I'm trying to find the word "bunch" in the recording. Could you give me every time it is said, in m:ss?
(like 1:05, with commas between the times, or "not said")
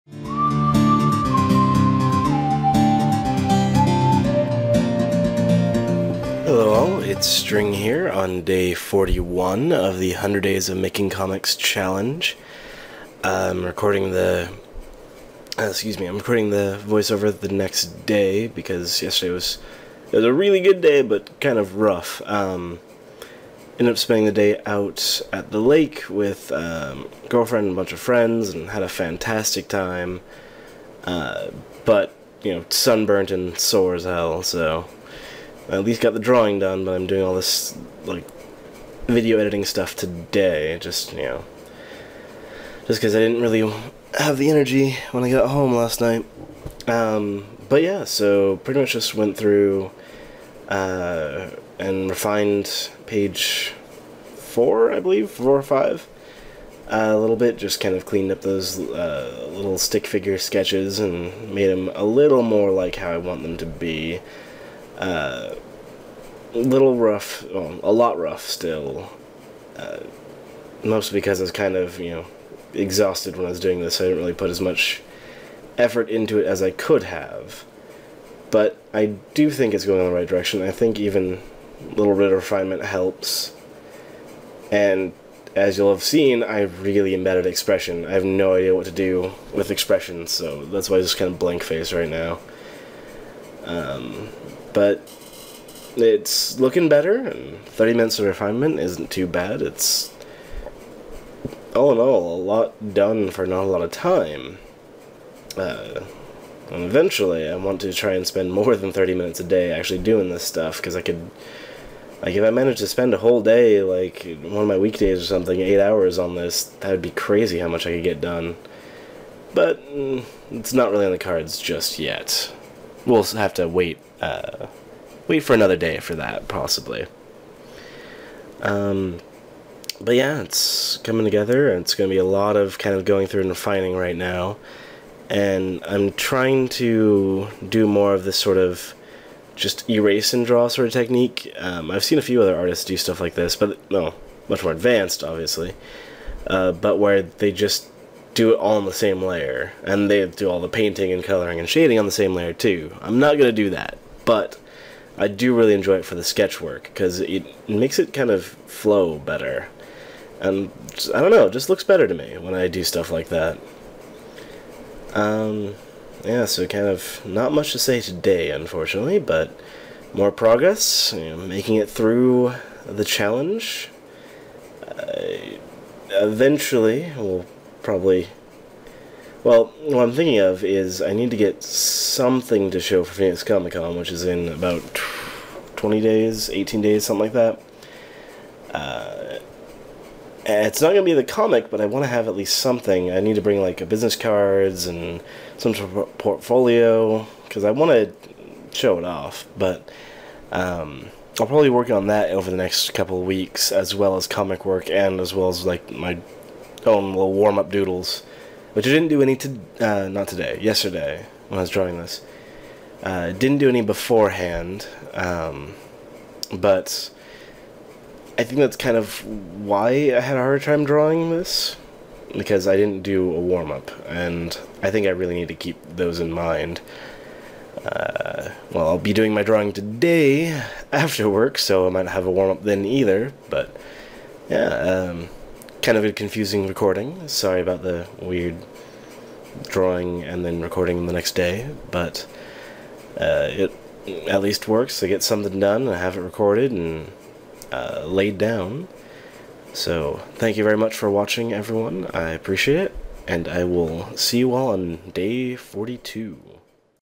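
0:27.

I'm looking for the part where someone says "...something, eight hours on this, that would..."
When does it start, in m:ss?
1:55.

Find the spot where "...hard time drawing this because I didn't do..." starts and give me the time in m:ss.
3:40.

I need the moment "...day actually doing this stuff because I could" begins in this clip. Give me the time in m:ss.
1:49.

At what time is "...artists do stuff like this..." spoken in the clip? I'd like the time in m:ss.
2:22.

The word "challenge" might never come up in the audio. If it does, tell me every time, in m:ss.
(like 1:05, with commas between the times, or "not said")
0:11, 2:53.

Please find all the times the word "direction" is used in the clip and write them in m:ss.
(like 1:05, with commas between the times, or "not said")
1:20.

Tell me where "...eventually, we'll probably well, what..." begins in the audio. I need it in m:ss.
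2:56.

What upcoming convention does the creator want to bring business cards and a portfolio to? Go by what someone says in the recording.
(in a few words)
Phoenix Comic Con.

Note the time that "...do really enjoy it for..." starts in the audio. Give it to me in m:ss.
2:35.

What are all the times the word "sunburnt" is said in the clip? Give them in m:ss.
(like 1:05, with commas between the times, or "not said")
0:32.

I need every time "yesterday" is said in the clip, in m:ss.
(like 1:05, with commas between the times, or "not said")
0:19, 3:30.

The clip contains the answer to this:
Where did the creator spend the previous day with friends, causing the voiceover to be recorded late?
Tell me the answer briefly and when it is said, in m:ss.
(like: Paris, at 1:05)
The lake, at 0:25.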